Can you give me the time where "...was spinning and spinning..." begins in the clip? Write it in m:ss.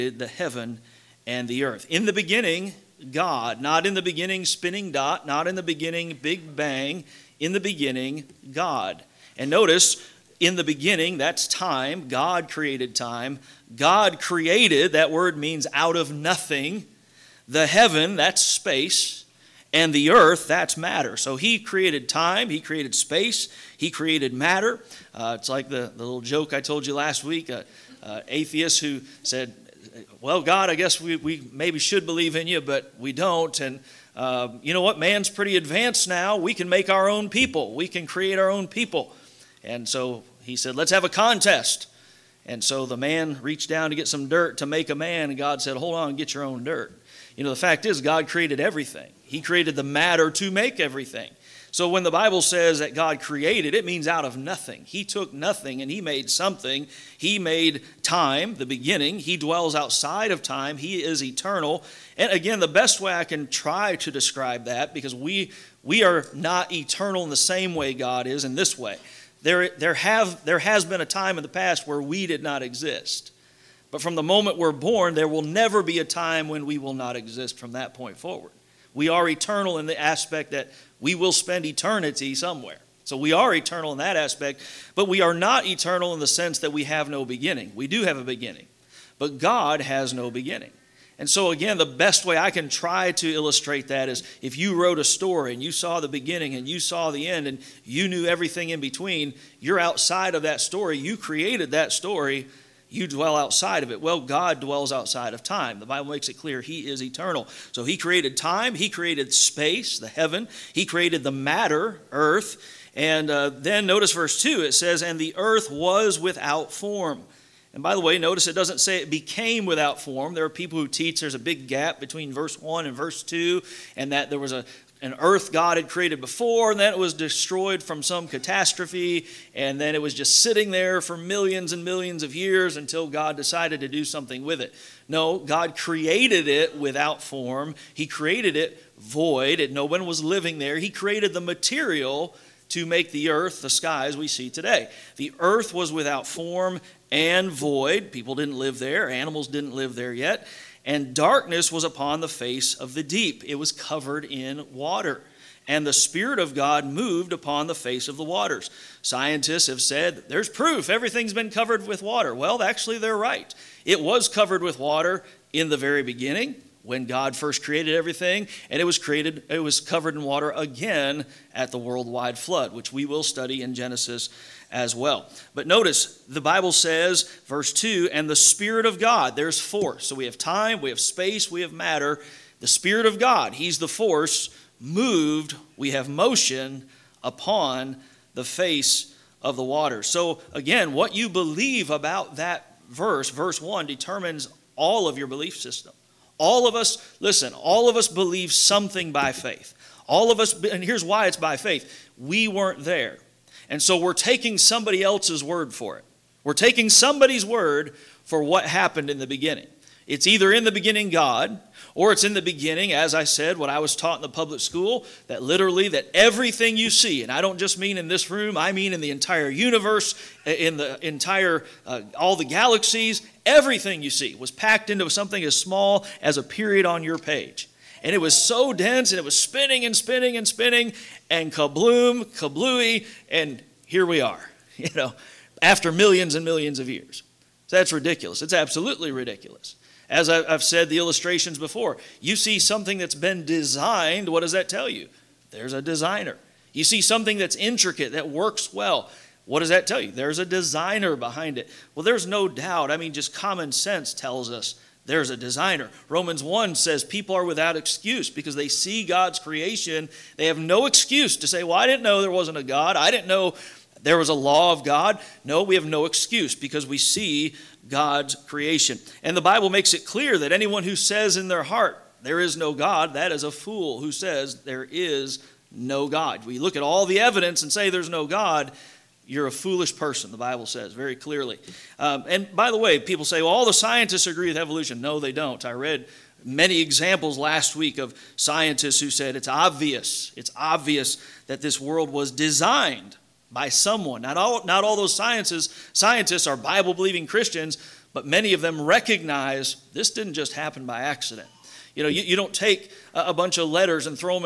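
3:49.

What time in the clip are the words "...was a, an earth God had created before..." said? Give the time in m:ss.
2:04.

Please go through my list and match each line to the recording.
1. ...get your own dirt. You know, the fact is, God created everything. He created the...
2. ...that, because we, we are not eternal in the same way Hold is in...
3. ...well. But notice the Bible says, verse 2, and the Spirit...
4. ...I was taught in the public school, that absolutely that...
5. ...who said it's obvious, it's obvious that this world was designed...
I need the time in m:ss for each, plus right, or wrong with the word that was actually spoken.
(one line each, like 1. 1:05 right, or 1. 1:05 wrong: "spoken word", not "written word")
1. 0:46 right
2. 1:04 wrong: "God", not "Hold"
3. 2:54 right
4. 3:33 wrong: "literally", not "absolutely"
5. 4:49 right.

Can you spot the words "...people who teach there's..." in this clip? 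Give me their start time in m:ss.
2:00.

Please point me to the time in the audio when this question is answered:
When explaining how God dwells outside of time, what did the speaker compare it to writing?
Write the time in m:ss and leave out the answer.
1:34.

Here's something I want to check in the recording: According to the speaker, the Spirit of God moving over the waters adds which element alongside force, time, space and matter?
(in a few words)
motion.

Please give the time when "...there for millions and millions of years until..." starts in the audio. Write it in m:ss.
2:10.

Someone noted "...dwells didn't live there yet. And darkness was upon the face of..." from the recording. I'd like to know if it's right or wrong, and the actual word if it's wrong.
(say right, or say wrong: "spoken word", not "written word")
wrong: "animals", not "dwells".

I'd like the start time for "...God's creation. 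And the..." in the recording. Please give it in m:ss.
4:27.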